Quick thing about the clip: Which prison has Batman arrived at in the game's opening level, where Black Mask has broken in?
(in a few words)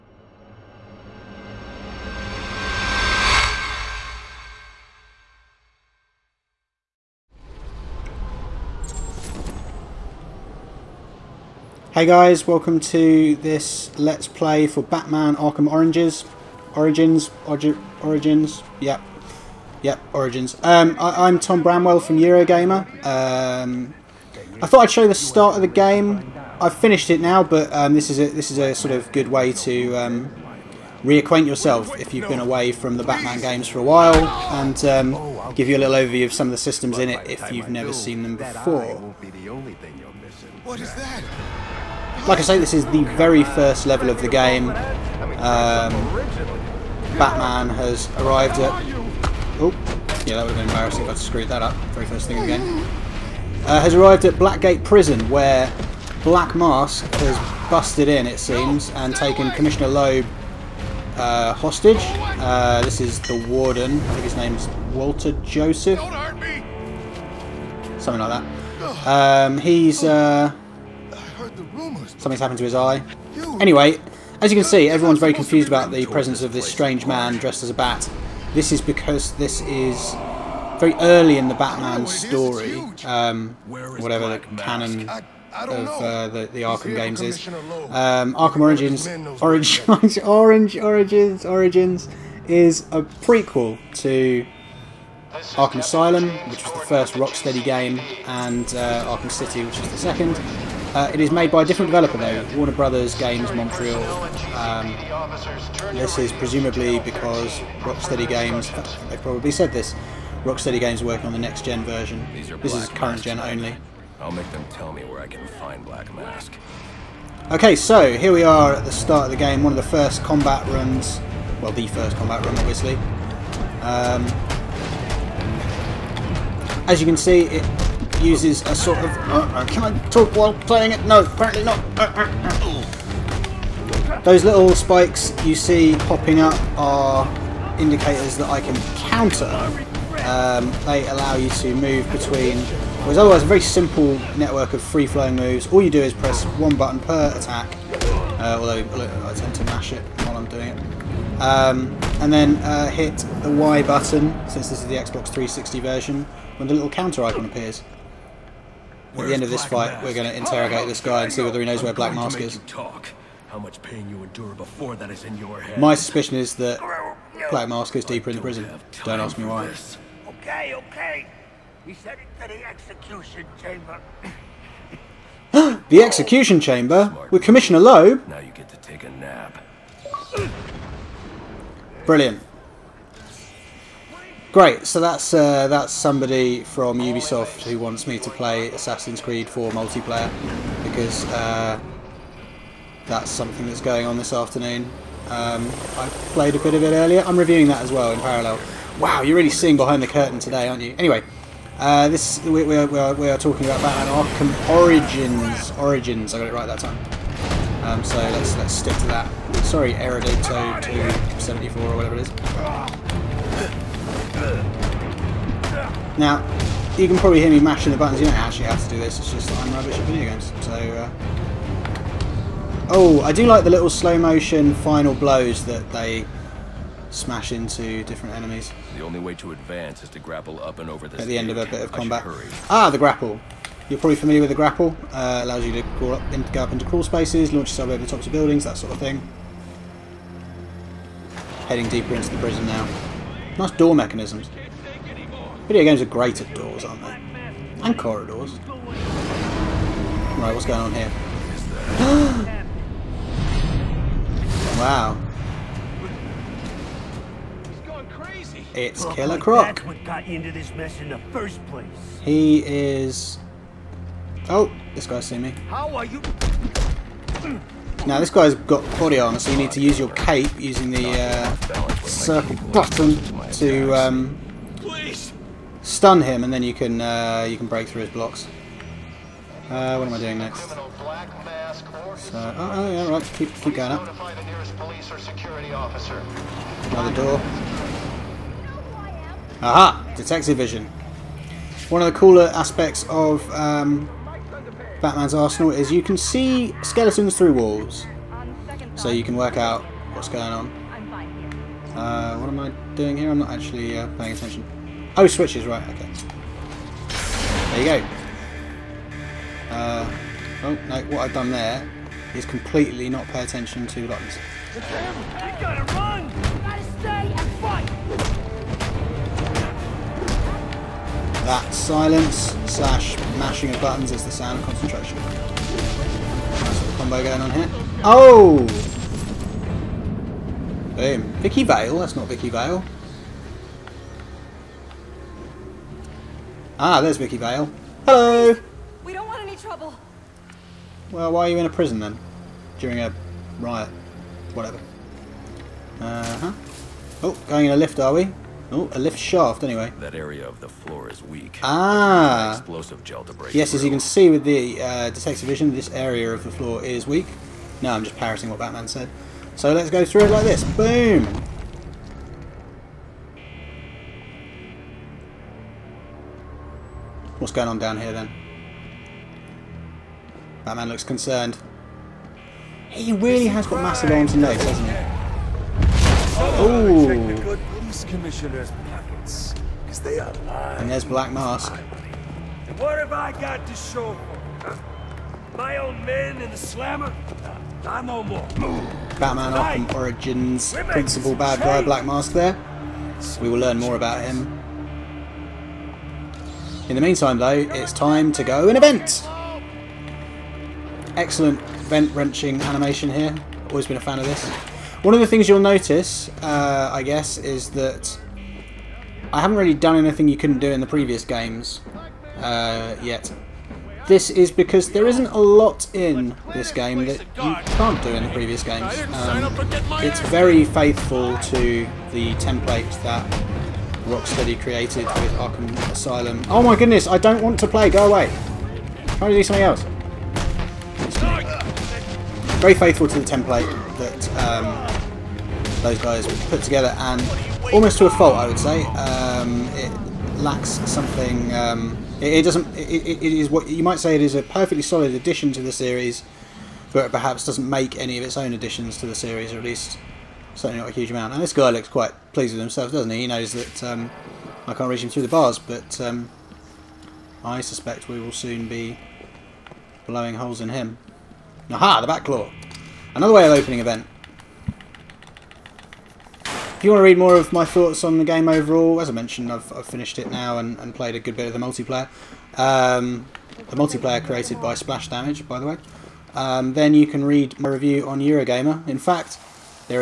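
Blackgate Prison.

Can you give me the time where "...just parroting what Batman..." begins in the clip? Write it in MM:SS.
05:58.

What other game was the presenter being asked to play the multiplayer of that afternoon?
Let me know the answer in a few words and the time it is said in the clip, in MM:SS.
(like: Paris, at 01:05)
Assassin's Creed 4, at 03:08.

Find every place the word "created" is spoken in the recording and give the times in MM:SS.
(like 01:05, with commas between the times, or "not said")
07:04, 07:54.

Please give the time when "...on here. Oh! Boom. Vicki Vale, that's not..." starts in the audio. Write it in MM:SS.
05:27.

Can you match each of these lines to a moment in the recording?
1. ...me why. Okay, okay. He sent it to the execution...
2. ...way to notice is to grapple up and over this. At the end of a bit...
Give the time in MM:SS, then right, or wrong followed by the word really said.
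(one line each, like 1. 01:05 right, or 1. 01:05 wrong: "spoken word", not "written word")
1. 02:49 right
2. 03:49 wrong: "advance", not "notice".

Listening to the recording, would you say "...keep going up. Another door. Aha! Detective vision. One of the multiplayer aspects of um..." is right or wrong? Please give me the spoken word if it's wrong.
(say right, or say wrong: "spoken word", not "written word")
wrong: "cooler", not "multiplayer".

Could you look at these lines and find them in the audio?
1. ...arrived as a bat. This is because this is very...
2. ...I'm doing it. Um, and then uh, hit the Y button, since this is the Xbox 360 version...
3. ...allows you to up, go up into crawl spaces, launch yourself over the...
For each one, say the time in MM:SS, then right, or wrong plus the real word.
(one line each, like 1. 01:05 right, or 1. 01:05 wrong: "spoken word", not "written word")
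1. 01:17 wrong: "dressed", not "arrived"
2. 02:30 right
3. 03:55 right.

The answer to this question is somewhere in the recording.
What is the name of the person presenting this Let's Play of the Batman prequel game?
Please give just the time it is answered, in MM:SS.
00:21.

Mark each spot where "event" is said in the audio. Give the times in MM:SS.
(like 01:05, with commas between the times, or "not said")
06:38, 07:43.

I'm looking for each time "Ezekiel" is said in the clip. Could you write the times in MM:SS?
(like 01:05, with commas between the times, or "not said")
not said.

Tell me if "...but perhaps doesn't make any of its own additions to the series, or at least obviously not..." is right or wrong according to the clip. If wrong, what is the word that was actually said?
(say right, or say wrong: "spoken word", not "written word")
wrong: "certainly", not "obviously".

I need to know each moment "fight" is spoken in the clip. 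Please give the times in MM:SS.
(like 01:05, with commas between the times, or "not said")
02:39, 05:17.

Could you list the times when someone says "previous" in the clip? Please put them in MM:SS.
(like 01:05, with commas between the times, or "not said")
06:50, 06:58.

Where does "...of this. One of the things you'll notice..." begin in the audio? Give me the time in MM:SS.
06:44.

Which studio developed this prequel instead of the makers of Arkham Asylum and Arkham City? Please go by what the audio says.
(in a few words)
Warner Brothers Games Montreal.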